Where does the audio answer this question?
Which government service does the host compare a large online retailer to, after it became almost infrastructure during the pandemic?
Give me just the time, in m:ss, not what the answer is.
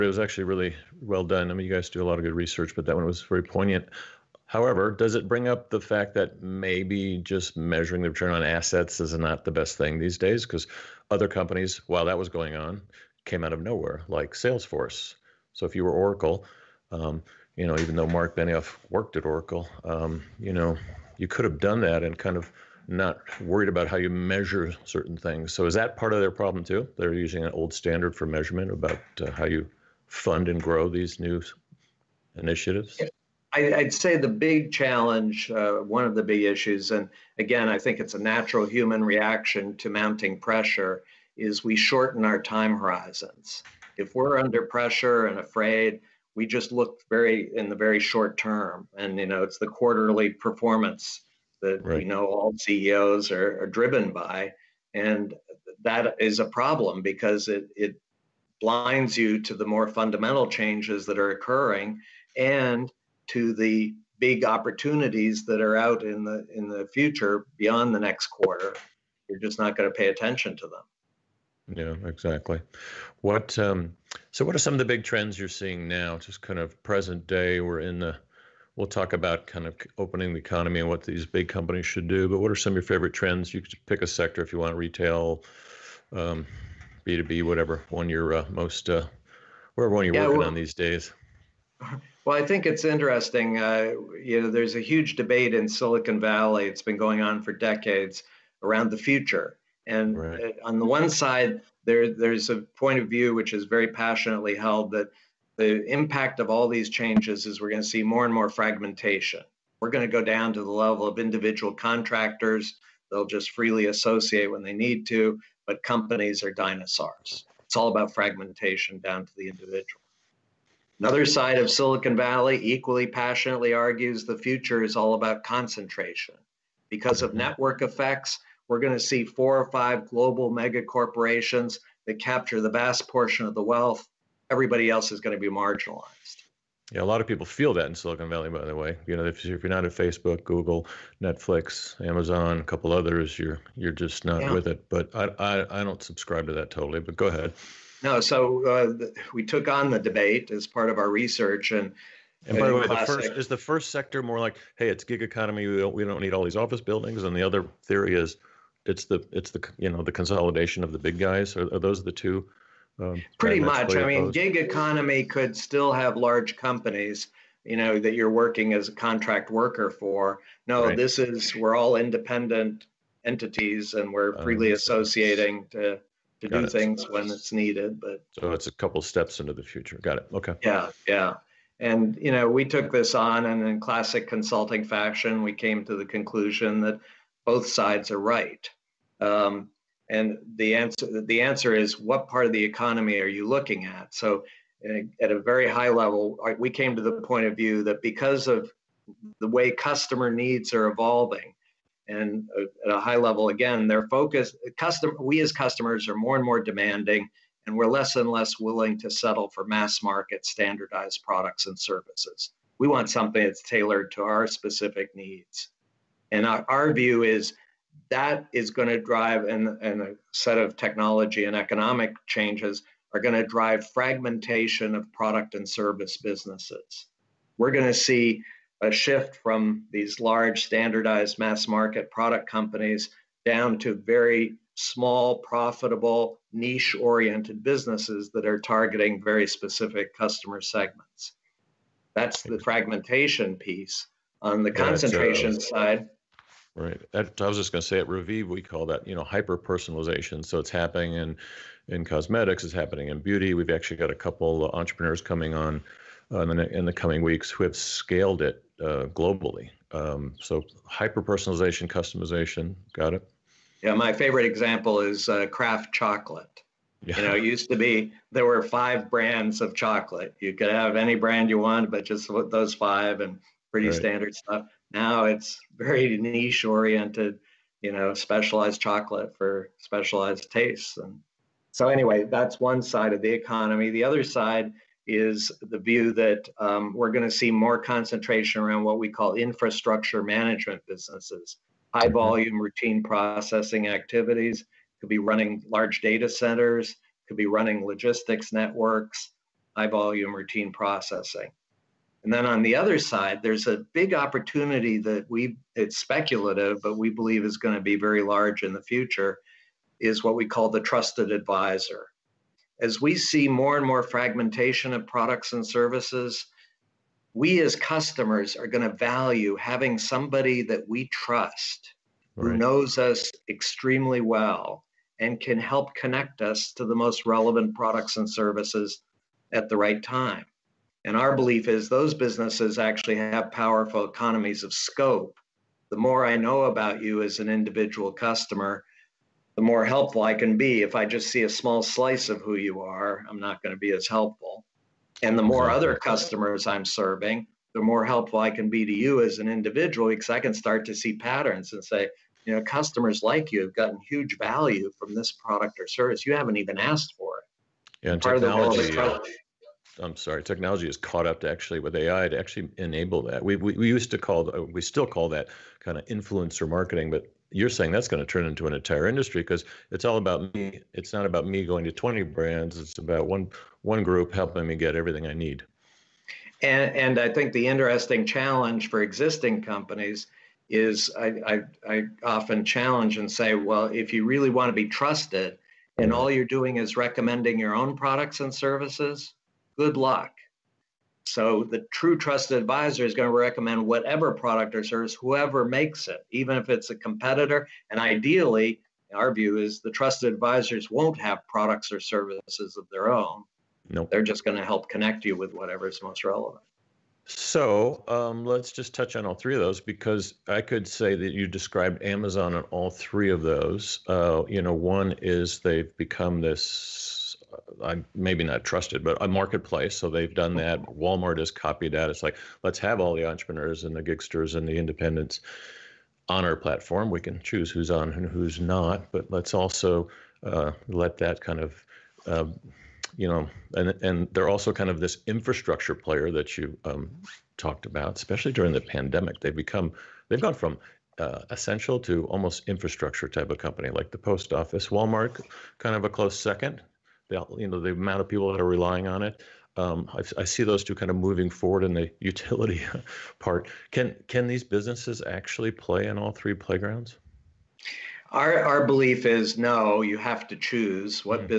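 7:24.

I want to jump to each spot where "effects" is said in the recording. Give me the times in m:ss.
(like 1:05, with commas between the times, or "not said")
2:07.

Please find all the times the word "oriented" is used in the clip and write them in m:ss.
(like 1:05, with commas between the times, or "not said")
3:56, 4:36.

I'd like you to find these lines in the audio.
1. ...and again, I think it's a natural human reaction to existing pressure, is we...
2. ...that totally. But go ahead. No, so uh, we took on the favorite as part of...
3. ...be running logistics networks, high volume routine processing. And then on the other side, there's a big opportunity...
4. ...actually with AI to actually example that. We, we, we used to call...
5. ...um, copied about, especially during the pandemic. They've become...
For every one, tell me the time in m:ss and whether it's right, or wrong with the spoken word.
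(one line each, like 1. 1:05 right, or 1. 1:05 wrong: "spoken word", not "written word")
1. 0:36 wrong: "mounting", not "existing"
2. 2:26 wrong: "debate", not "favorite"
3. 4:57 right
4. 6:01 wrong: "enable", not "example"
5. 7:16 wrong: "talked", not "copied".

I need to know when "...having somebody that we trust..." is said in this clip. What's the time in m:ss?
5:19.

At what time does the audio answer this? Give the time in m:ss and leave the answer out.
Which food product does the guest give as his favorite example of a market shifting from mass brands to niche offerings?
4:25.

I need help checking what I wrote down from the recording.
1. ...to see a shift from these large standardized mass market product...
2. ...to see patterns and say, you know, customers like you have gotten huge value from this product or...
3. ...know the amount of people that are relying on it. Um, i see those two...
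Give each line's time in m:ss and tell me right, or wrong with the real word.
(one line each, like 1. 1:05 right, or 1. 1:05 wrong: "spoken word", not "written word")
1. 3:47 right
2. 5:50 right
3. 7:27 right.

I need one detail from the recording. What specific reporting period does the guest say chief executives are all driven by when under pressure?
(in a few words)
quarterly performance.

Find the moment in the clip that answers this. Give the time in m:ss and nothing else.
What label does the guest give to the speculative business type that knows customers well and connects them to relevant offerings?
5:10.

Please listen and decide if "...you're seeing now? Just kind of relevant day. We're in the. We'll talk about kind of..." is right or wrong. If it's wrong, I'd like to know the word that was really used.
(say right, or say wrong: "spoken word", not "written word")
wrong: "present", not "relevant".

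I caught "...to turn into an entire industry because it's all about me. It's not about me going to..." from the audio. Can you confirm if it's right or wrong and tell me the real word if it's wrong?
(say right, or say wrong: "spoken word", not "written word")
right.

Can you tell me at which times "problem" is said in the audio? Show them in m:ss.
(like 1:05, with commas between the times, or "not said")
0:26, 0:56.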